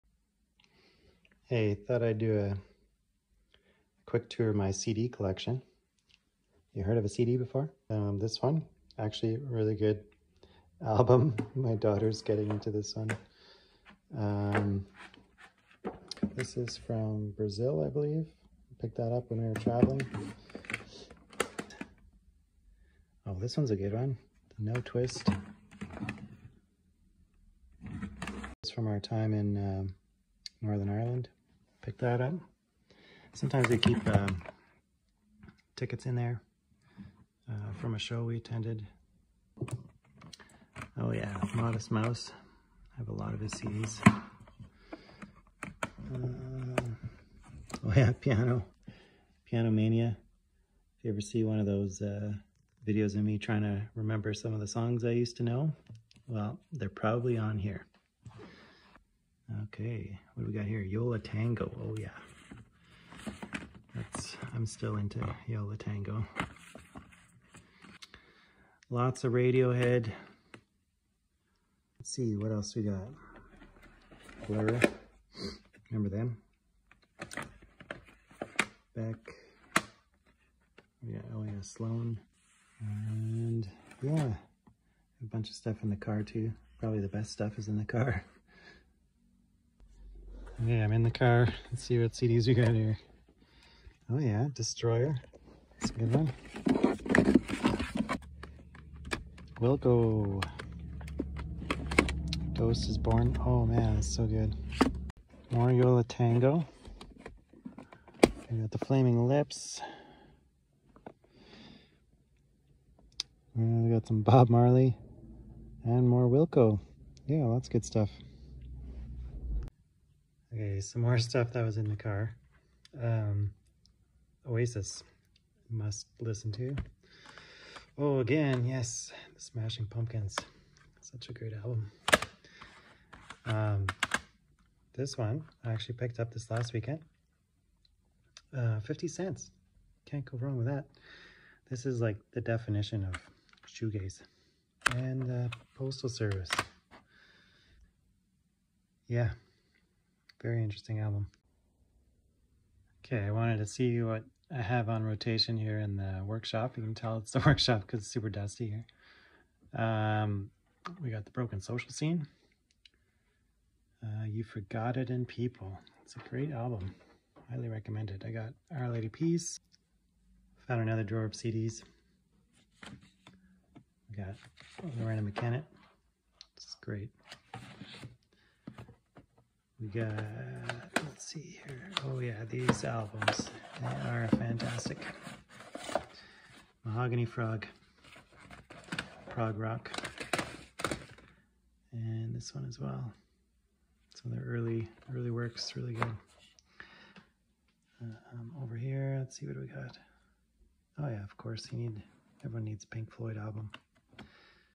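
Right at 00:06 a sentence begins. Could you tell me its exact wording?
You heard of a CD before?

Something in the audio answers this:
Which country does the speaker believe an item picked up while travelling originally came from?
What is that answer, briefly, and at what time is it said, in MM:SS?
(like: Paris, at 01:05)
Brazil, at 00:17.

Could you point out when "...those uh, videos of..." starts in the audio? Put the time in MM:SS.
00:51.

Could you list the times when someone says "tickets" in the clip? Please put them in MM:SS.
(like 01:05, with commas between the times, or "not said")
00:35.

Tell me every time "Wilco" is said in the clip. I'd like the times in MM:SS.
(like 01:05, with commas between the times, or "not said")
01:39, 01:56.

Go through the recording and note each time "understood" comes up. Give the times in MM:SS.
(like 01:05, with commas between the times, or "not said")
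not said.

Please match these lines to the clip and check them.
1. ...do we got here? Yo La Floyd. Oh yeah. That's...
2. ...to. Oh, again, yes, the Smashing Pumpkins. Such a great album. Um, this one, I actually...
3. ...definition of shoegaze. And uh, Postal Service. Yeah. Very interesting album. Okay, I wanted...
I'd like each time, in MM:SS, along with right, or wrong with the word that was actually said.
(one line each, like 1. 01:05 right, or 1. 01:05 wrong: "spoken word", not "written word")
1. 01:00 wrong: "Tengo", not "Floyd"
2. 02:06 right
3. 02:22 right.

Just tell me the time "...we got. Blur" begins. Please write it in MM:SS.
01:12.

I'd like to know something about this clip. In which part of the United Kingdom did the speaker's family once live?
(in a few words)
Northern Ireland.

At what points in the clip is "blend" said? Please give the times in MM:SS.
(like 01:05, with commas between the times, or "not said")
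not said.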